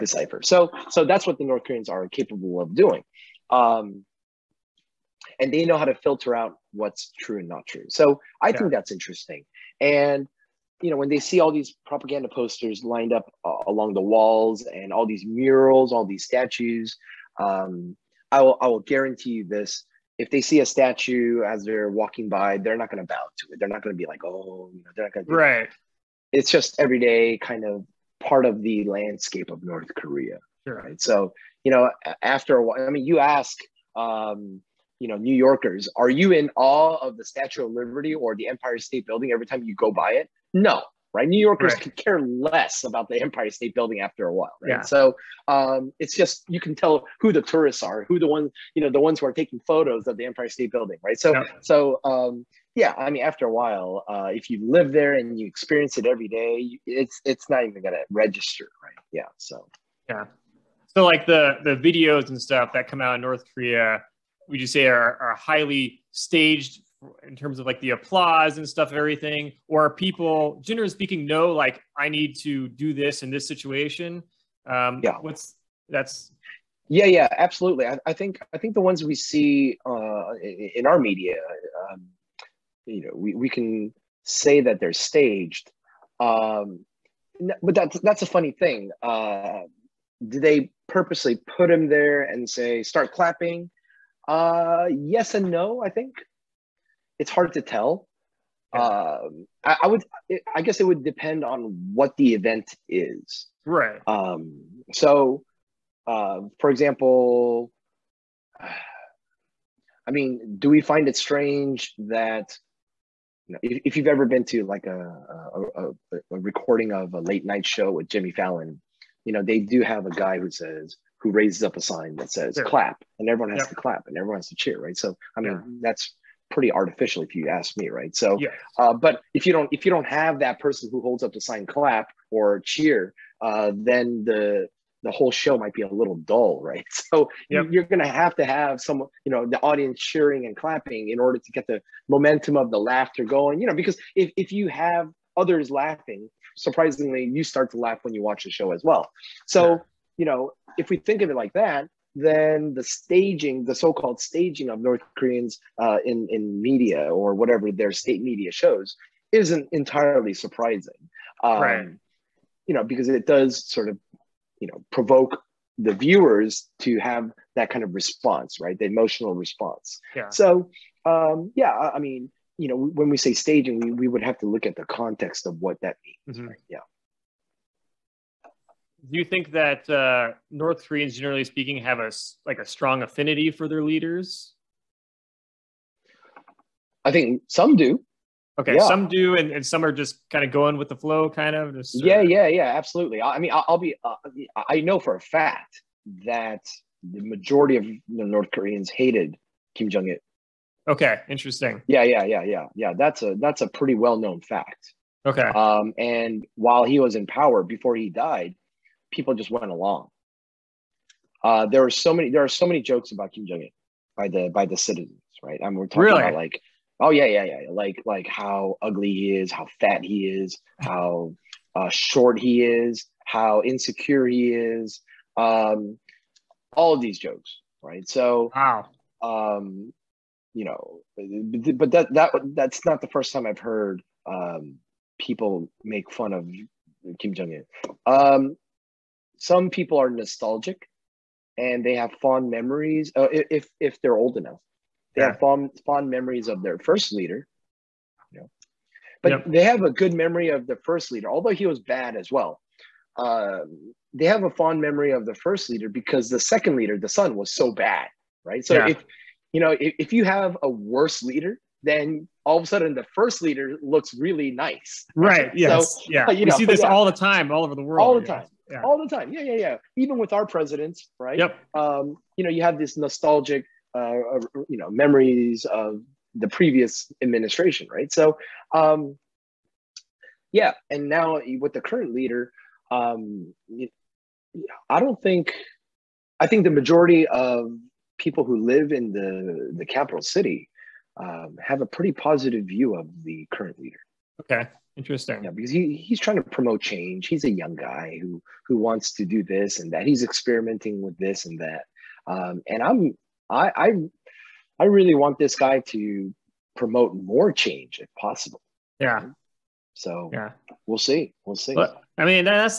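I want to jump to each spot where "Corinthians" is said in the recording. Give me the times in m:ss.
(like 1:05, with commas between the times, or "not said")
not said.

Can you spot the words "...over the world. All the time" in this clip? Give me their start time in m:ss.
4:27.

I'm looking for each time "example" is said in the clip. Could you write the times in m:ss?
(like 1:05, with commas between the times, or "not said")
1:46.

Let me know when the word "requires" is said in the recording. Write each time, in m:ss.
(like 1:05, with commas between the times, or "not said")
not said.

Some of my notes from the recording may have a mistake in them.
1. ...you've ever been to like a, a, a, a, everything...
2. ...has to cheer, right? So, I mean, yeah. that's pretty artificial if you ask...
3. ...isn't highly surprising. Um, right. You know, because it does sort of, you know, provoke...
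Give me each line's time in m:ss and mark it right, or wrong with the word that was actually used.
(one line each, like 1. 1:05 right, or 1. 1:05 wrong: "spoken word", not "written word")
1. 1:53 wrong: "recording", not "everything"
2. 2:04 right
3. 2:39 wrong: "entirely", not "highly".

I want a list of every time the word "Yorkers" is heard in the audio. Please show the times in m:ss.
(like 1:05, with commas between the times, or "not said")
0:35, 0:41.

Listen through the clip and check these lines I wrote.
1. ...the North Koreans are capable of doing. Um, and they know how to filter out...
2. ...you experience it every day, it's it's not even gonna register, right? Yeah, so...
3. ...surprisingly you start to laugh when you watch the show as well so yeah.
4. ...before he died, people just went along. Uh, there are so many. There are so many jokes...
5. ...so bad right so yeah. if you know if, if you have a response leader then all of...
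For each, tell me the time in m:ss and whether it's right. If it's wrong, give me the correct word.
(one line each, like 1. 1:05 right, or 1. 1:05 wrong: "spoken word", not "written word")
1. 0:01 right
2. 0:55 right
3. 2:26 right
4. 3:27 right
5. 4:17 wrong: "worse", not "response".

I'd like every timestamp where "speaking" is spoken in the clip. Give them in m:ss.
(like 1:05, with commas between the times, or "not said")
1:10, 3:01.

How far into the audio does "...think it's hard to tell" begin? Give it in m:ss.
1:35.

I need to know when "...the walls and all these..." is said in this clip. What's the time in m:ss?
0:13.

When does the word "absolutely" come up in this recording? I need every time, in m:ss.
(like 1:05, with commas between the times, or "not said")
1:17, 3:12.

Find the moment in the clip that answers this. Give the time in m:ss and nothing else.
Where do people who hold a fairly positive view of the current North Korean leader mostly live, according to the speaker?
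4:49.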